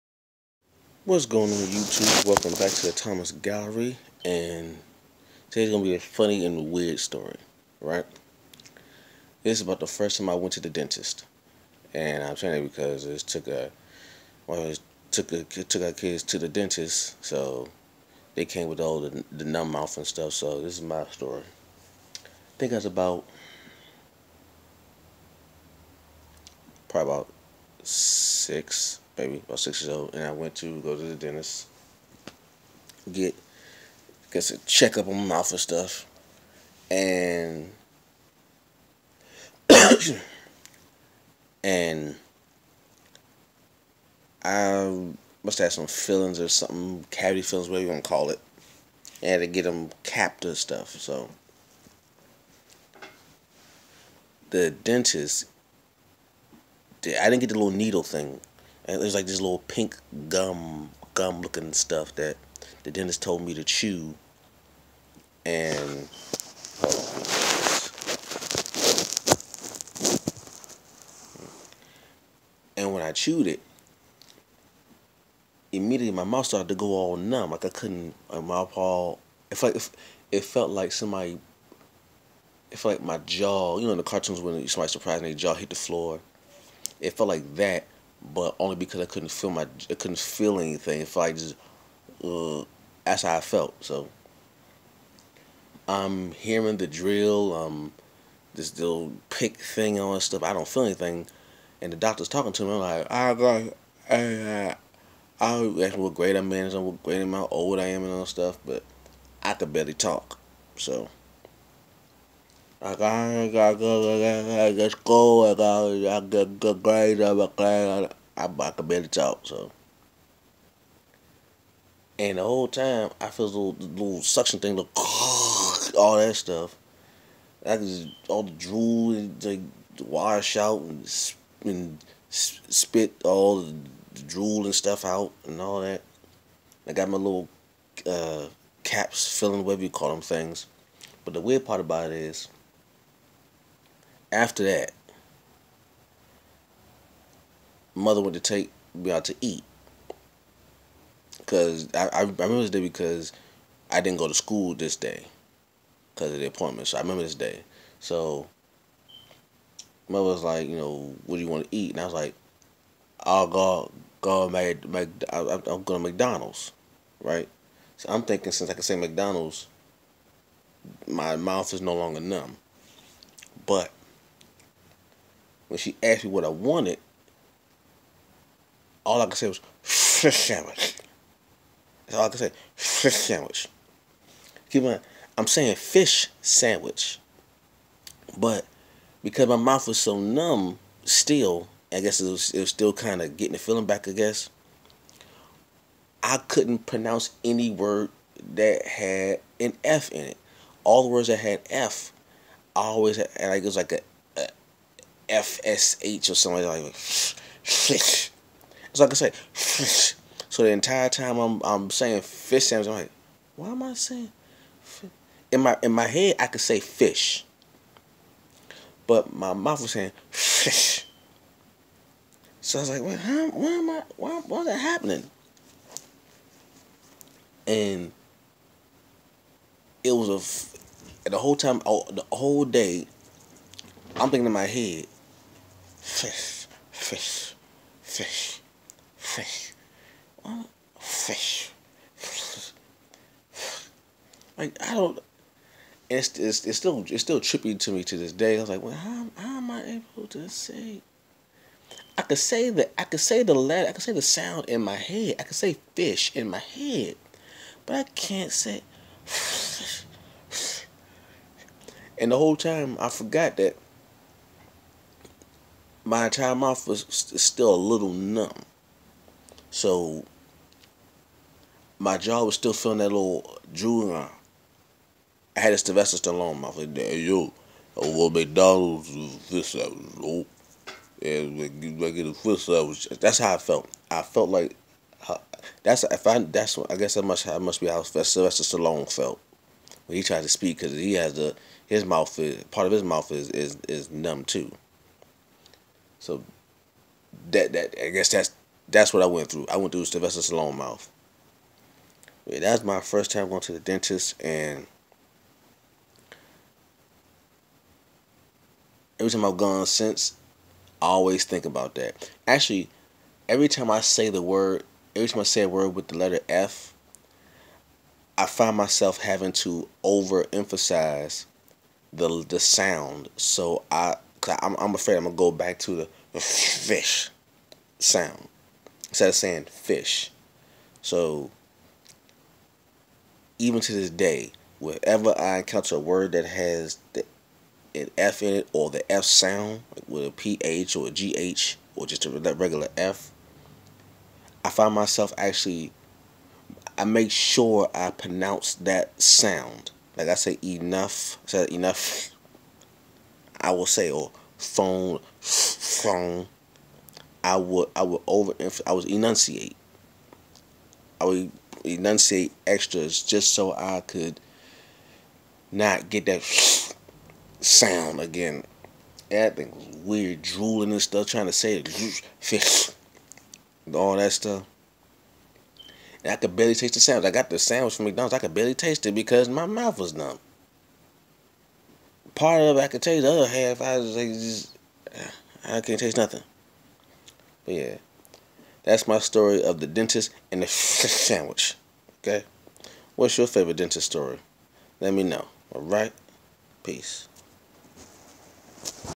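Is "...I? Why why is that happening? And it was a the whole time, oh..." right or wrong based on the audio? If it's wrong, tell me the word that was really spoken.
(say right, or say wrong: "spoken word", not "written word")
right.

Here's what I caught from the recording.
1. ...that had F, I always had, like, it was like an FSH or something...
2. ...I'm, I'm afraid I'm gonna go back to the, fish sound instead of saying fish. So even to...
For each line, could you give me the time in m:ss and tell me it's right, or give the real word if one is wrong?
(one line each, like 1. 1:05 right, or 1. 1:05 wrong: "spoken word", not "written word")
1. 3:21 right
2. 5:24 right.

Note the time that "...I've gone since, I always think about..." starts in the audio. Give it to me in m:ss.
5:09.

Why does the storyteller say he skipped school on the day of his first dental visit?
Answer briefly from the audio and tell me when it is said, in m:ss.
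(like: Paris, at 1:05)
the appointment, at 2:36.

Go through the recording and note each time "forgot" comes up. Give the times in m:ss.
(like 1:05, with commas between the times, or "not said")
4:23.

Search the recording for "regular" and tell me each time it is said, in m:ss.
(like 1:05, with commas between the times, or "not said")
5:42.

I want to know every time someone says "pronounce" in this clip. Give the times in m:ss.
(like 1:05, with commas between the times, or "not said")
3:16, 5:48.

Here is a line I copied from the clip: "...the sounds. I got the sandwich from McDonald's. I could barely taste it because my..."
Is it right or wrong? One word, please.
right.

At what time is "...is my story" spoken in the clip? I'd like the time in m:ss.
0:20.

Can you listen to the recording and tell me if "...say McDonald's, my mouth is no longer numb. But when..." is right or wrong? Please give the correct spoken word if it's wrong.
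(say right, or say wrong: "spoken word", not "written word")
right.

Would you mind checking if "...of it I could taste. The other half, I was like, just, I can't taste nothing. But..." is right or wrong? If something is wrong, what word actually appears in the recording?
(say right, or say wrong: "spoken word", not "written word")
right.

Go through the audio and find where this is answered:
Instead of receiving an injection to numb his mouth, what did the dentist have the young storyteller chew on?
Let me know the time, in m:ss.
0:59.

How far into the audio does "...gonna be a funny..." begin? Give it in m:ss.
0:05.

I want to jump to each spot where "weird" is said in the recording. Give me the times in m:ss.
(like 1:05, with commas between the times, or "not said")
0:06, 2:21, 6:10.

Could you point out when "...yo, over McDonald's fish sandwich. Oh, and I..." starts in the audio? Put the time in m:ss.
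4:37.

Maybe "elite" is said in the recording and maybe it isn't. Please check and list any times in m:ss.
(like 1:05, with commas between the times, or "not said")
not said.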